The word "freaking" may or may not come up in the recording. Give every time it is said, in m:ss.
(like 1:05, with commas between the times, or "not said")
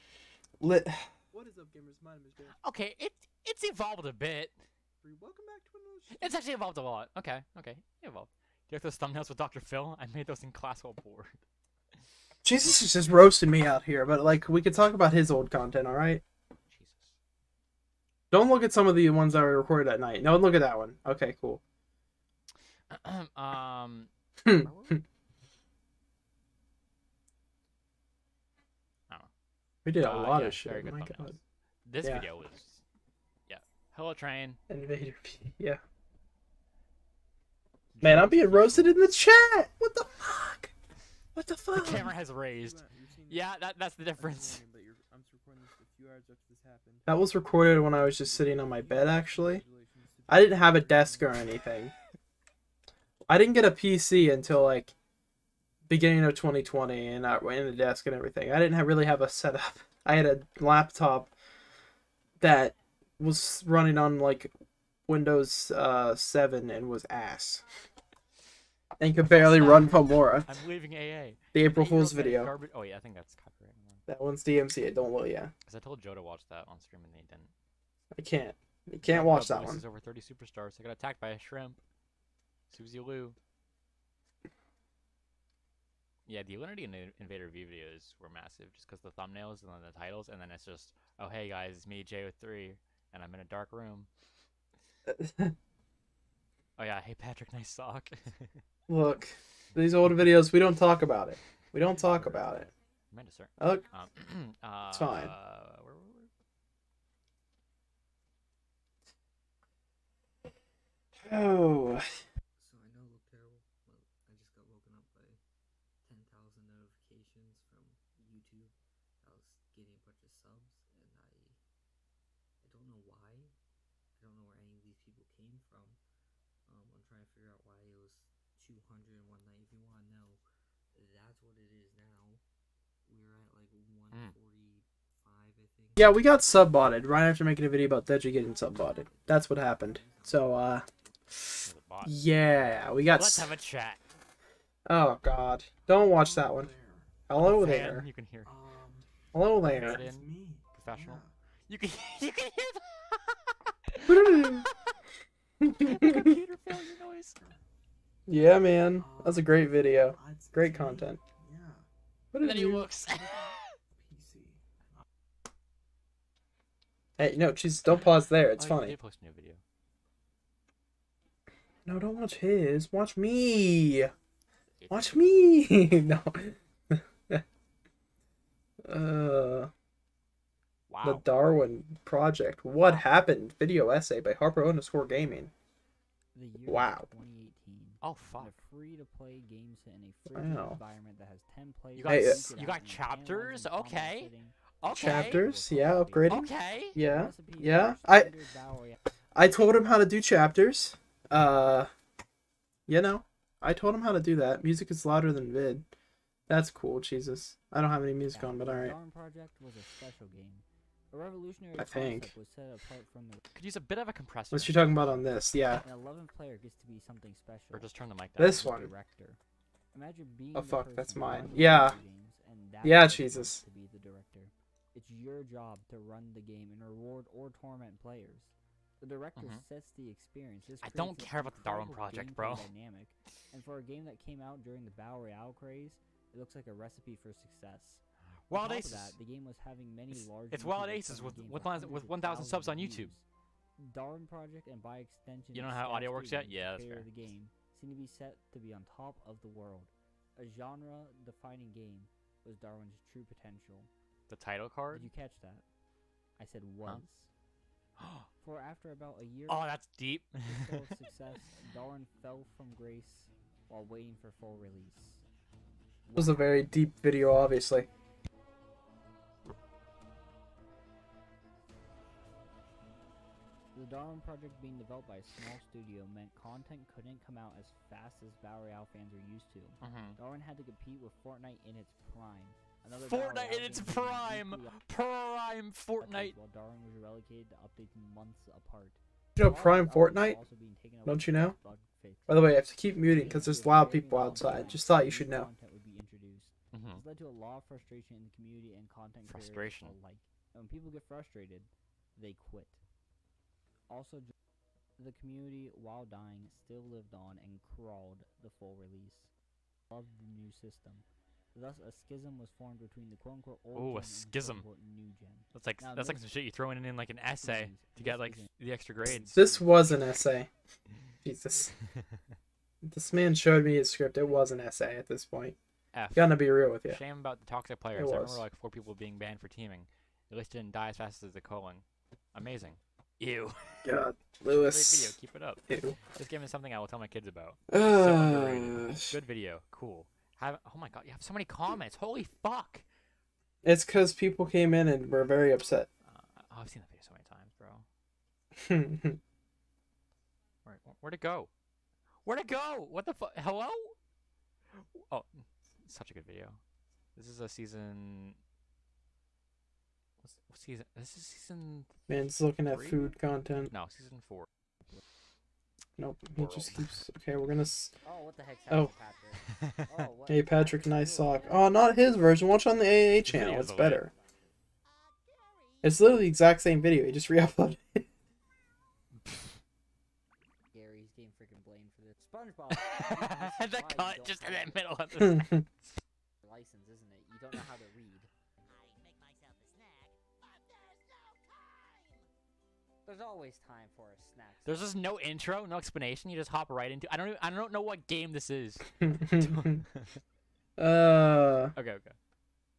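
6:21.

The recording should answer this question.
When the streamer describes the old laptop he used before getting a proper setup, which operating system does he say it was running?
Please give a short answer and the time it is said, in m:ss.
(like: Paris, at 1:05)
Windows 7, at 1:05.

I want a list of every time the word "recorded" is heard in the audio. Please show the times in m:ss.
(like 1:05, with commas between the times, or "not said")
0:19, 0:47.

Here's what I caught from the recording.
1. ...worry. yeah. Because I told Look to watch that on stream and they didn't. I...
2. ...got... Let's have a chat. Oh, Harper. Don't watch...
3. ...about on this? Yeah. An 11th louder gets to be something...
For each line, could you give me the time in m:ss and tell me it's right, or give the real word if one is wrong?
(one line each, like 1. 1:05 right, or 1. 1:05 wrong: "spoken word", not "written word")
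1. 1:15 wrong: "Joe", not "Look"
2. 2:23 wrong: "God", not "Harper"
3. 3:34 wrong: "player", not "louder".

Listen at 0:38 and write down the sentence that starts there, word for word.
Man, I'm being roasted in the chat.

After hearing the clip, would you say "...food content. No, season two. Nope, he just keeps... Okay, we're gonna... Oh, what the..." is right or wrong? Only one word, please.
wrong.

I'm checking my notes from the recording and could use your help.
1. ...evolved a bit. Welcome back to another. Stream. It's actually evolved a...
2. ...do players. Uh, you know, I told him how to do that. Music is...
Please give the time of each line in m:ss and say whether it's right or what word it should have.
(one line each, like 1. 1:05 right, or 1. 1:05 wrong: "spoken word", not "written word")
1. 0:03 right
2. 3:20 wrong: "chapters", not "players".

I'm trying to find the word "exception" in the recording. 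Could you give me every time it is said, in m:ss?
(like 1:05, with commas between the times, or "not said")
not said.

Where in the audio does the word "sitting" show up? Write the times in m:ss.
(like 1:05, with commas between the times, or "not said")
0:48, 3:14.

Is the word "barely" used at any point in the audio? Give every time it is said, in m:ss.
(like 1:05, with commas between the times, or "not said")
1:09.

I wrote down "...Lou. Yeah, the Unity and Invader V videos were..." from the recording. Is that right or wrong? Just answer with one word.
right.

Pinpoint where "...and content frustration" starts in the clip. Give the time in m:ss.
4:58.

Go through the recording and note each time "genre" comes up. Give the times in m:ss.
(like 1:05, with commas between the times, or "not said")
4:10.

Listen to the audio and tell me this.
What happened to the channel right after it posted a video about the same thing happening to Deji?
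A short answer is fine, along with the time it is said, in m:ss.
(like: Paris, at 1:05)
got subbotted, at 2:16.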